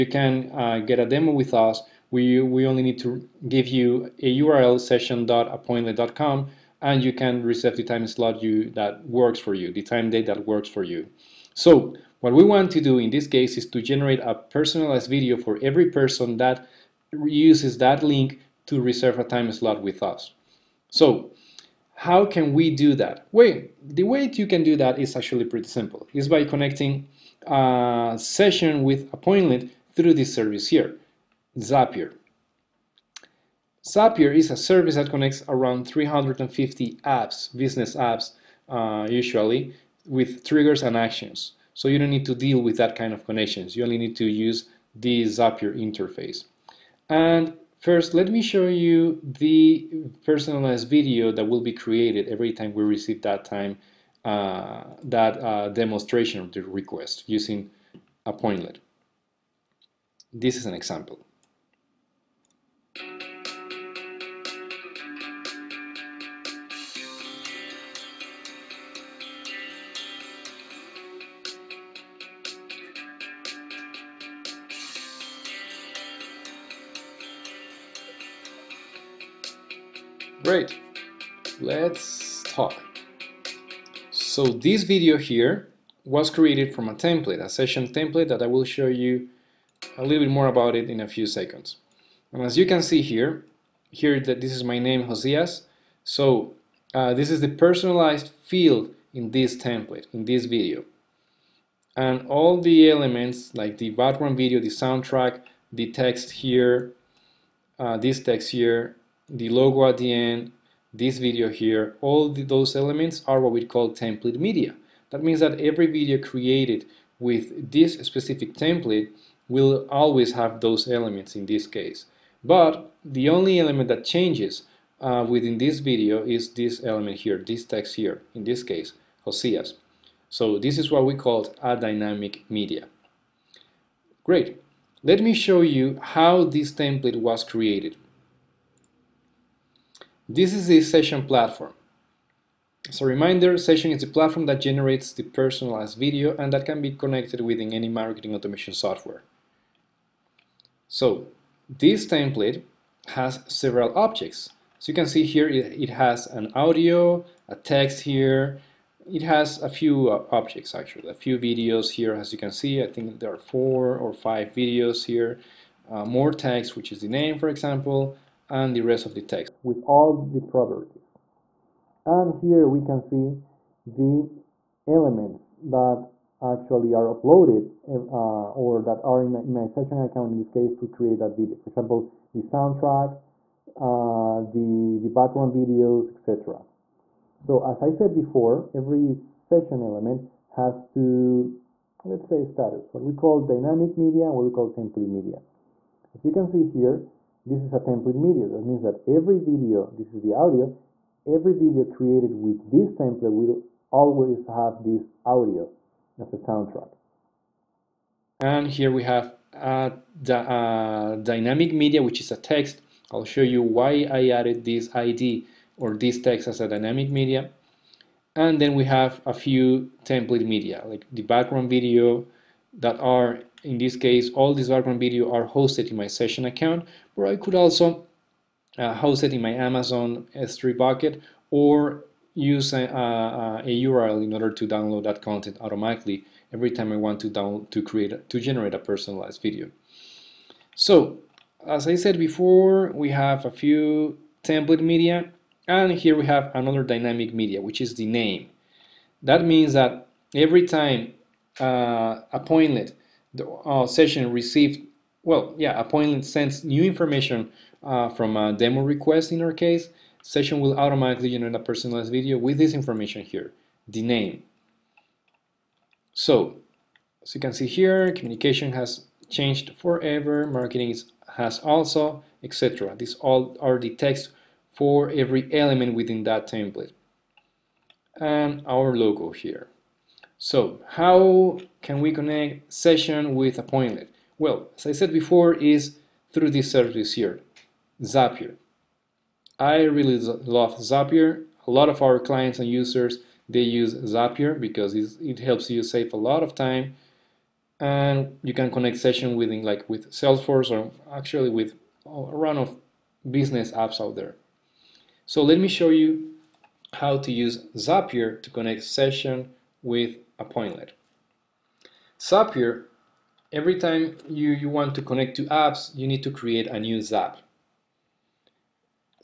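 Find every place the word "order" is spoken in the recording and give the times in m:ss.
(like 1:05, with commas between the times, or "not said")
3:54.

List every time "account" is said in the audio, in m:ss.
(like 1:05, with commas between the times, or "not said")
3:00, 3:46.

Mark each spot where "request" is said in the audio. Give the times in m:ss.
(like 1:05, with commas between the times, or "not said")
0:56, 4:18.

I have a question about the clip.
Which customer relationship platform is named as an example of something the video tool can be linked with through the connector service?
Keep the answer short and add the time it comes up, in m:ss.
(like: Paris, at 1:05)
Salesforce, at 5:00.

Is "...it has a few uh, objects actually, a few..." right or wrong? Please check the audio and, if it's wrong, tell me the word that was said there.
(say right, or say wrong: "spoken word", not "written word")
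right.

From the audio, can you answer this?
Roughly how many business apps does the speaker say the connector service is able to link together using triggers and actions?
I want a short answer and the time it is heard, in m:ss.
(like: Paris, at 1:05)
350, at 0:35.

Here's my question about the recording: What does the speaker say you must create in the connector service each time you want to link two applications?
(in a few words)
a new zap.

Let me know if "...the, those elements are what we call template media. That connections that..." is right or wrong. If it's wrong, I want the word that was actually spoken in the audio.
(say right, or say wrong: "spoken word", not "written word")
wrong: "means", not "connections".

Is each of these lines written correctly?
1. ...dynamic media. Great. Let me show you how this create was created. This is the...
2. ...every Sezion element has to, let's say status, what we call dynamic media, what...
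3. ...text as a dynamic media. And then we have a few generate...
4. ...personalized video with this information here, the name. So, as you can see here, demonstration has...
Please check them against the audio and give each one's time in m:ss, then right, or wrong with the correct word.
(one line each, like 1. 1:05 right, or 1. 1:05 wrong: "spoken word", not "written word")
1. 2:11 wrong: "template", not "create"
2. 3:08 right
3. 3:36 wrong: "template", not "generate"
4. 4:21 wrong: "communication", not "demonstration".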